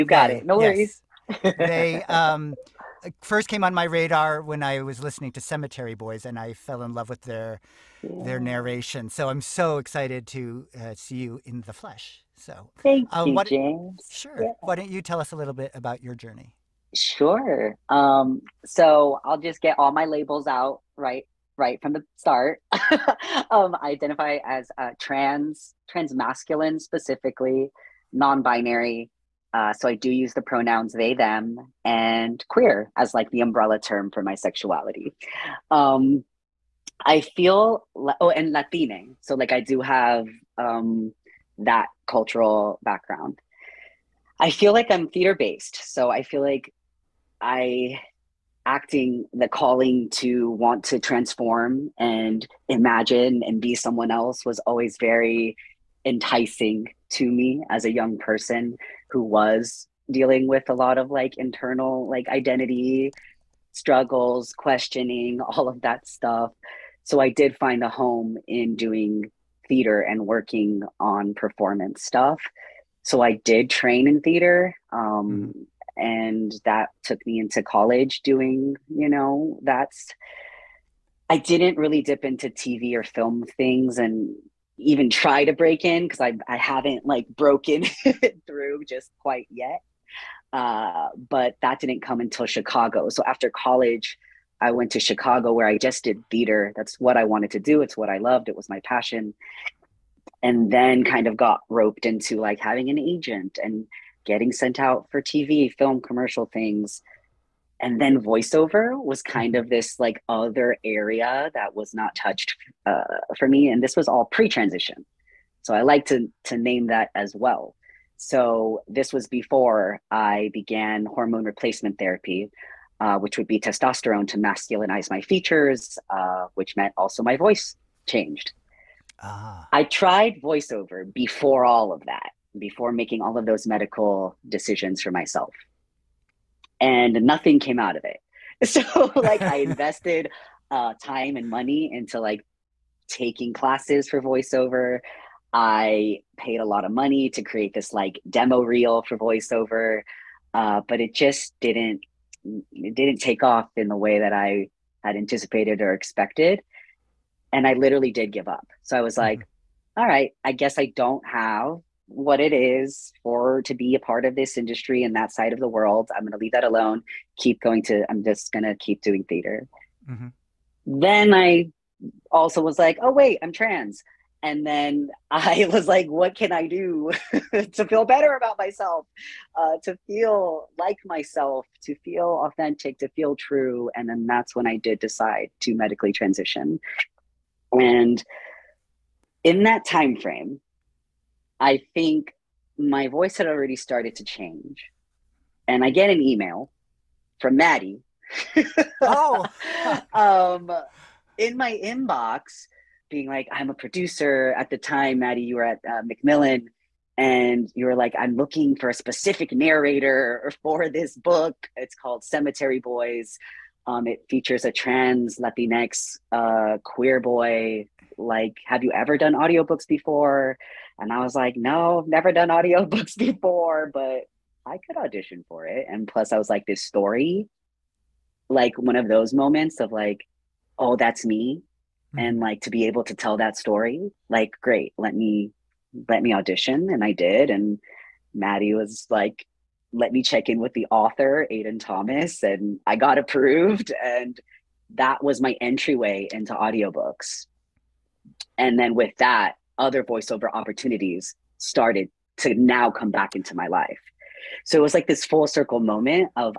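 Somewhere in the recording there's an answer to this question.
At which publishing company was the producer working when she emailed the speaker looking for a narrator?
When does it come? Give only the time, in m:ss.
3:26.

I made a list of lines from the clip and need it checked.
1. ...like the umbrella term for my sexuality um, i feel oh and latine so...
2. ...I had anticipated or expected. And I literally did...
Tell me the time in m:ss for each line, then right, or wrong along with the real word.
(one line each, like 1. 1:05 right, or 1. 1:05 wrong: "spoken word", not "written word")
1. 0:33 right
2. 2:34 right.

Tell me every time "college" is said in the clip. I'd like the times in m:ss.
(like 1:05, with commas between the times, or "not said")
1:17, 1:33.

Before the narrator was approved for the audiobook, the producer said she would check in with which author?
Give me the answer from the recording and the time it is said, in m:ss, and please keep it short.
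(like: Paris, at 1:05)
Aiden Thomas, at 4:01.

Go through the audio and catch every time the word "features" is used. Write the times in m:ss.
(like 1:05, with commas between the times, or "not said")
2:05, 3:34.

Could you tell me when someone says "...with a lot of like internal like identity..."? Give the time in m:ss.
1:00.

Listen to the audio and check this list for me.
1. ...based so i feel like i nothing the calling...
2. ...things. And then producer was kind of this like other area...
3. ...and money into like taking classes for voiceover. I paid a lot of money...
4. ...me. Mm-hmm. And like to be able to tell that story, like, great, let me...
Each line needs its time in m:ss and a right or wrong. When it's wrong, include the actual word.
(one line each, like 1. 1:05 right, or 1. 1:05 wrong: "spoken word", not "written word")
1. 0:45 wrong: "acting", not "nothing"
2. 1:46 wrong: "voiceover", not "producer"
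3. 2:21 right
4. 3:51 right.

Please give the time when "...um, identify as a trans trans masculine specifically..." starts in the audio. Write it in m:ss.
0:23.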